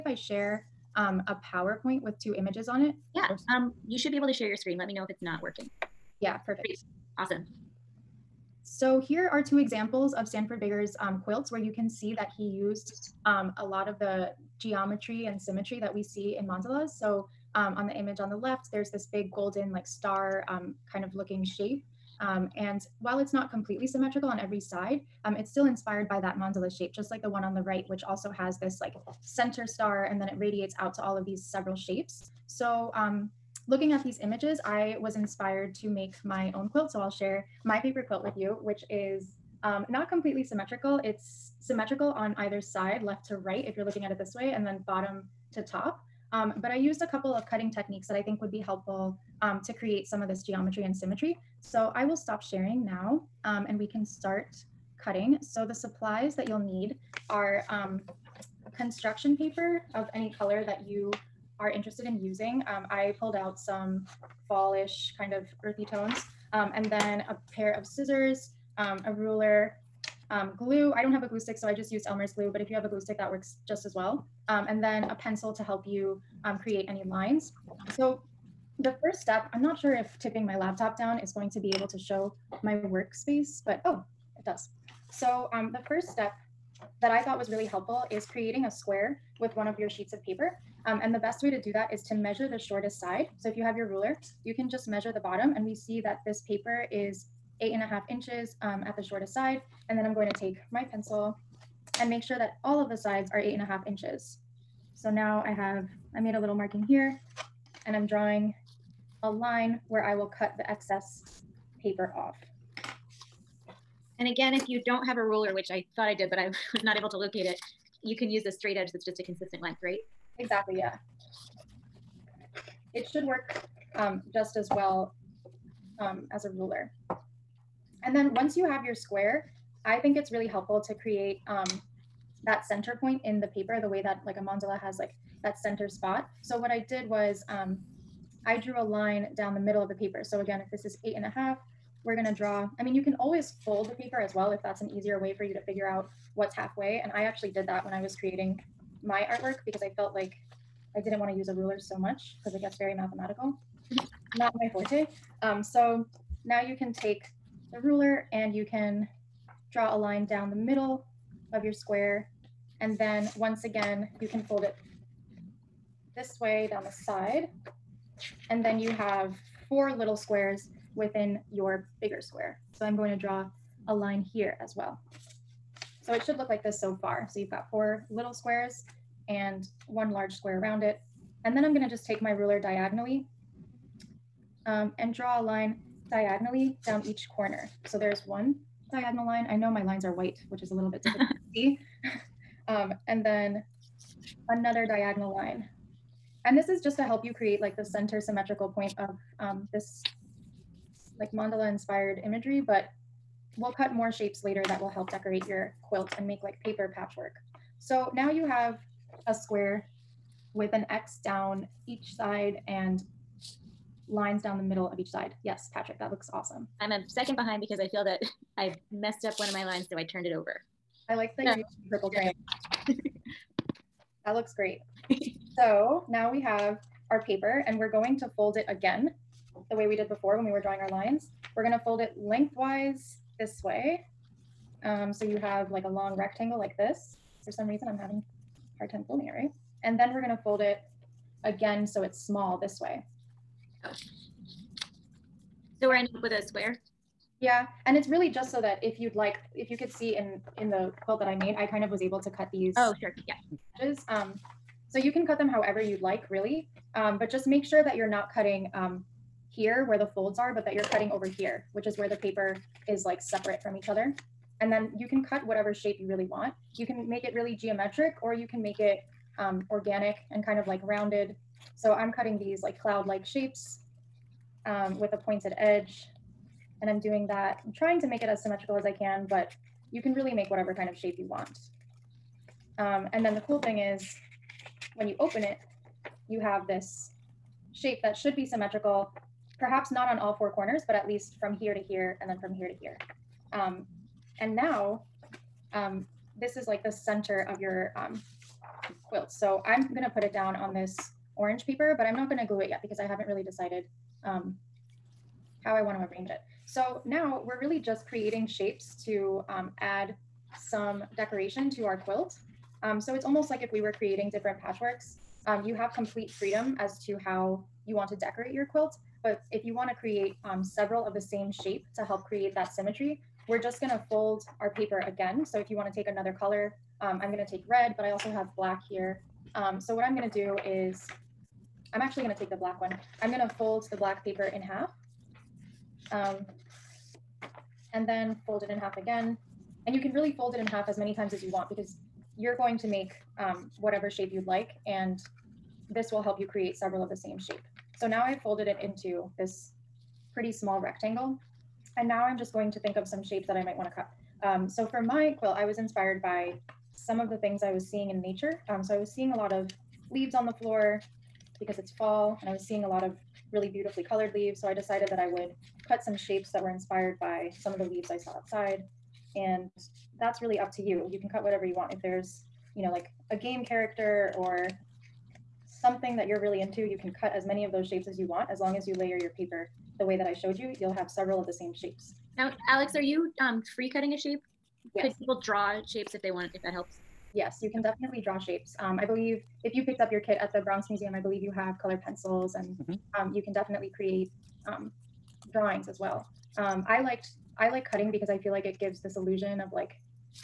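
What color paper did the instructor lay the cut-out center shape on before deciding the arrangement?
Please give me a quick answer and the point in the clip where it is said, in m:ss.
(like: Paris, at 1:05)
Orange, at 5:01.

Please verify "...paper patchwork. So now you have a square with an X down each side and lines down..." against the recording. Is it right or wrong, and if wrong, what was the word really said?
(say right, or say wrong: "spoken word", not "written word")
right.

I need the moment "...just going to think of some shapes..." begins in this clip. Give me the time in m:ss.
5:52.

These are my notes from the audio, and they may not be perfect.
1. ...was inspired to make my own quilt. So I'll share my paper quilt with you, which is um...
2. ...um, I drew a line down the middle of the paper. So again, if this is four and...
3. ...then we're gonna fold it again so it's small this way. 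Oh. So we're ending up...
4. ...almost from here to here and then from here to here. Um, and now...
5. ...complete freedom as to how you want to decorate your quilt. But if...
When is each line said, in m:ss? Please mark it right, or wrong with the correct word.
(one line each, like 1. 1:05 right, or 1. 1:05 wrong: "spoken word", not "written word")
1. 0:34 right
2. 2:17 wrong: "eight", not "four"
3. 3:59 right
4. 4:51 wrong: "least", not "almost"
5. 5:15 right.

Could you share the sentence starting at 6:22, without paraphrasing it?
Now, Alex, are you um, free cutting a shape?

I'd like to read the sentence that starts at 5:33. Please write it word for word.
I'm gonna fold the black paper in half.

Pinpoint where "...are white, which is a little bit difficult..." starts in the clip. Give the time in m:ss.
3:10.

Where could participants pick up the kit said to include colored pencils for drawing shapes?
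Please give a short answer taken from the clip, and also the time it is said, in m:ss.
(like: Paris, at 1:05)
Bronx Museum, at 6:30.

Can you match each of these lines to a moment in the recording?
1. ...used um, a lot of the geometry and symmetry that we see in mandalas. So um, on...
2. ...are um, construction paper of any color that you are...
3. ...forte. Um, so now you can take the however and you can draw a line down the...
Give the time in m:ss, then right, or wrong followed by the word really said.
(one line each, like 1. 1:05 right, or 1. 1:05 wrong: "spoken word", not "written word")
1. 0:12 right
2. 0:57 right
3. 2:34 wrong: "ruler", not "however".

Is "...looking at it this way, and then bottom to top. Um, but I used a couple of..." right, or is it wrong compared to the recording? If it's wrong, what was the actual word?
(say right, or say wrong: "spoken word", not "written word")
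right.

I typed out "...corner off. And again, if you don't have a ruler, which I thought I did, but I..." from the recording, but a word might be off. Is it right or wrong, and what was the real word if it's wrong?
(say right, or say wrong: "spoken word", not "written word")
wrong: "paper", not "corner".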